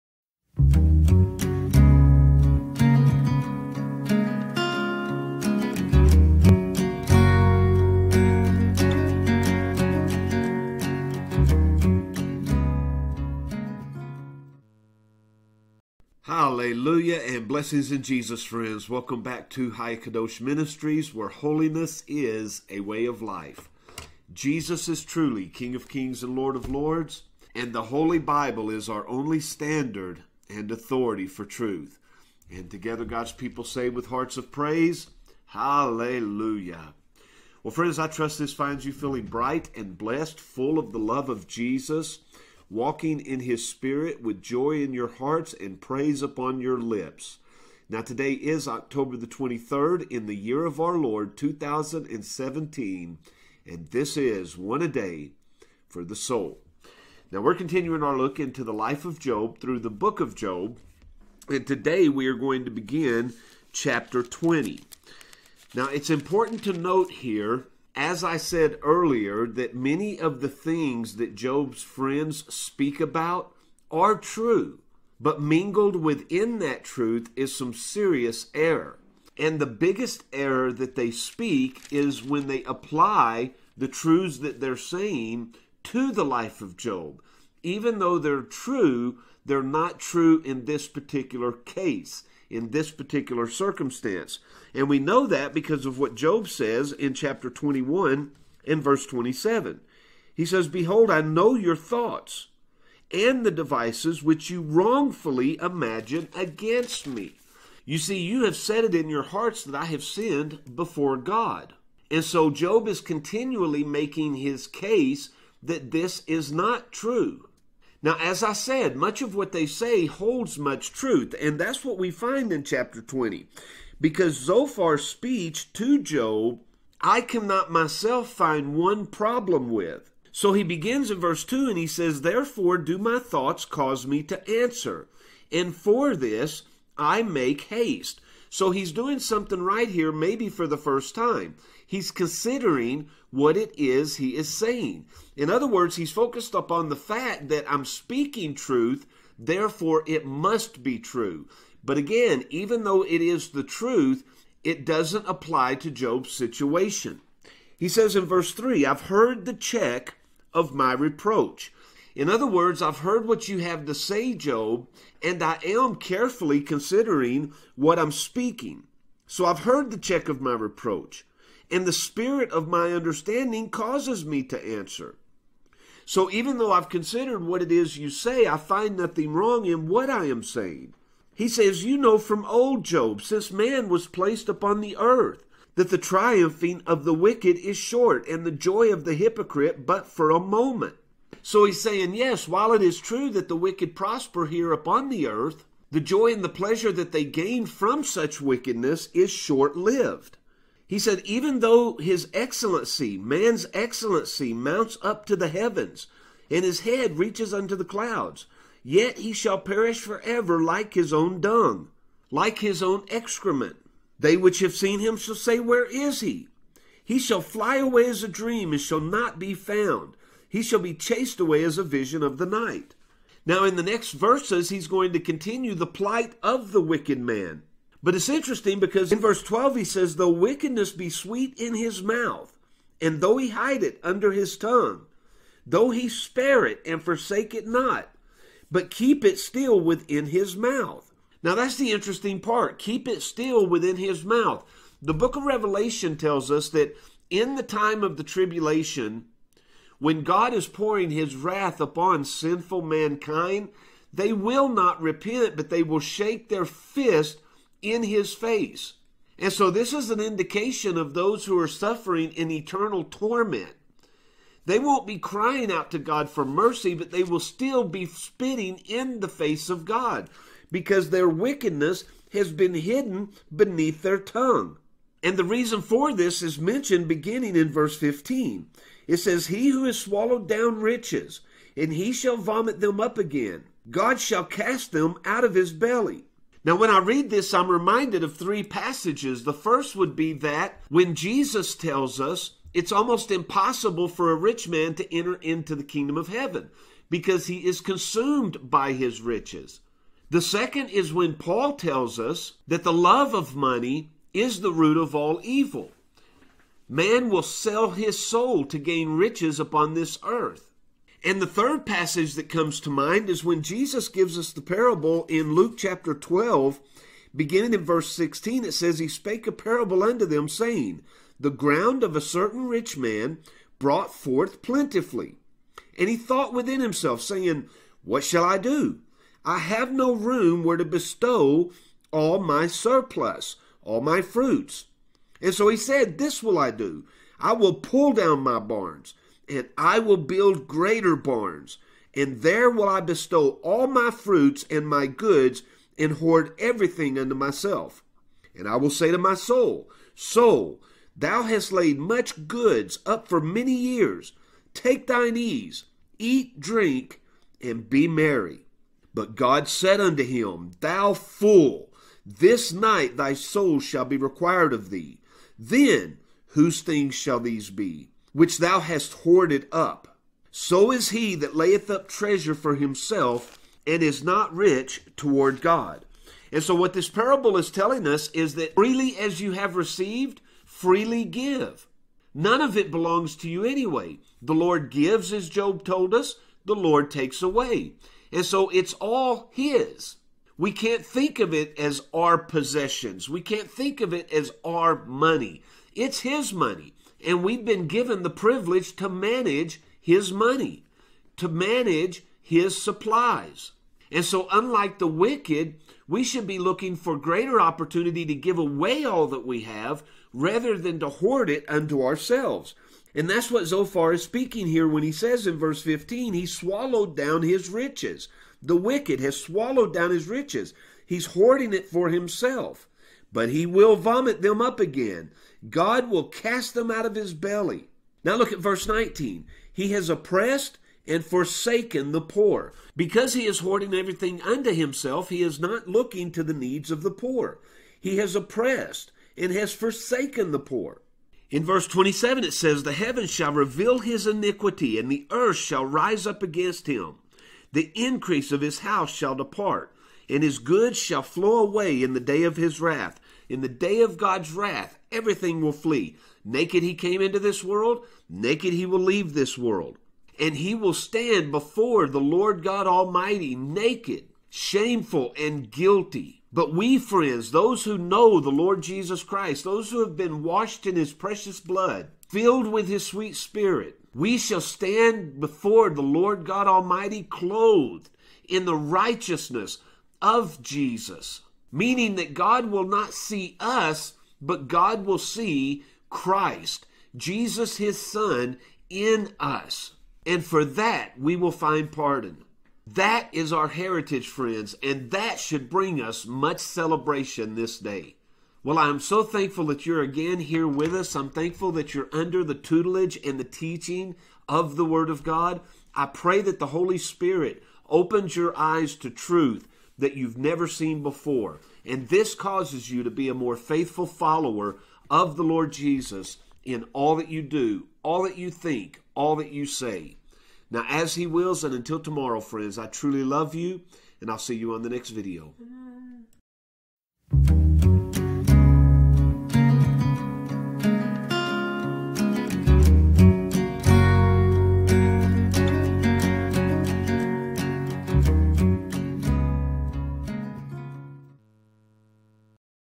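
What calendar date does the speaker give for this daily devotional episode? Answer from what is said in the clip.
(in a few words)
October 23, 2017.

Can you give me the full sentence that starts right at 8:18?
Well, I am so thankful that you're again here with us.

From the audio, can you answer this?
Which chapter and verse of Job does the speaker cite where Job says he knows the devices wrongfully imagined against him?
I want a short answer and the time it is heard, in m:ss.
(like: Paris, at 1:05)
Chapter 21, verse 27, at 1:37.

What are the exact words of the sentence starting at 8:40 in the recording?
Now, as He wills, and until tomorrow, friends, I truly love you, and I'll see you on the next video.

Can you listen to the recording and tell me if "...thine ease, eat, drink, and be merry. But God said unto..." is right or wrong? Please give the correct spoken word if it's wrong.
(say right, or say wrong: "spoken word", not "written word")
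right.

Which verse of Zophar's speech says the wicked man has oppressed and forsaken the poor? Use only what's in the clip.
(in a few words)
Verse 19.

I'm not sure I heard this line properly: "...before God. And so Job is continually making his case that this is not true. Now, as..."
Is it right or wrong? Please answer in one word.
right.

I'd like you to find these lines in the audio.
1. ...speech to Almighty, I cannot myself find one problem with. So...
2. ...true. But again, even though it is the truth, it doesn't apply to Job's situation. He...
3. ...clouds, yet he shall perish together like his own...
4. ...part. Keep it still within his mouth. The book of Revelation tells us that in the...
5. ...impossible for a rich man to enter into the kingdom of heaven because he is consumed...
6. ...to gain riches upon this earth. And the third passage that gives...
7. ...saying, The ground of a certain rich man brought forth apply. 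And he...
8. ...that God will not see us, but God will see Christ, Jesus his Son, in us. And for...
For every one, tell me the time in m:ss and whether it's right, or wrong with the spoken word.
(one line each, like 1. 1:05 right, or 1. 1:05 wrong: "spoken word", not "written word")
1. 2:05 wrong: "Job", not "Almighty"
2. 2:30 right
3. 3:27 wrong: "forever", not "together"
4. 4:02 right
5. 4:53 right
6. 5:08 wrong: "comes", not "gives"
7. 5:20 wrong: "plentifully", not "apply"
8. 8:02 right.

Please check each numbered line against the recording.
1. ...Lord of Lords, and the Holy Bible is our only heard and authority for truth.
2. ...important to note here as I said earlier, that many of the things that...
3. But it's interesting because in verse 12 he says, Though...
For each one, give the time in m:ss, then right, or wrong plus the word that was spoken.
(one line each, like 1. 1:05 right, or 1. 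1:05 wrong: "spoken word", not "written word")
1. 0:26 wrong: "standard", not "heard"
2. 1:06 right
3. 3:48 right.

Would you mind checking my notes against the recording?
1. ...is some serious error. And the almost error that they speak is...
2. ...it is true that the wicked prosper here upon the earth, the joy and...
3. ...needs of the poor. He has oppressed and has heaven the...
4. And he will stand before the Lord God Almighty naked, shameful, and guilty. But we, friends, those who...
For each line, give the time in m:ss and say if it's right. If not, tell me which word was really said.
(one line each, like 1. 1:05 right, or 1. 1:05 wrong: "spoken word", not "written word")
1. 1:17 wrong: "biggest", not "almost"
2. 3:12 right
3. 7:16 wrong: "forsaken", not "heaven"
4. 7:40 right.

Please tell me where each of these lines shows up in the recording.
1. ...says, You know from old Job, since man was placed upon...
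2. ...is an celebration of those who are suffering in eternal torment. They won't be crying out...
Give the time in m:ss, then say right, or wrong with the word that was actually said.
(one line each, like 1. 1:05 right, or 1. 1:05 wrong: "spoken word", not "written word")
1. 3:01 right
2. 4:19 wrong: "indication", not "celebration".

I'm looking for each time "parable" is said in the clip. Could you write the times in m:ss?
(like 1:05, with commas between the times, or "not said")
5:14, 5:19, 6:17.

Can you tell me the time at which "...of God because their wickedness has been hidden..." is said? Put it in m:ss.
4:29.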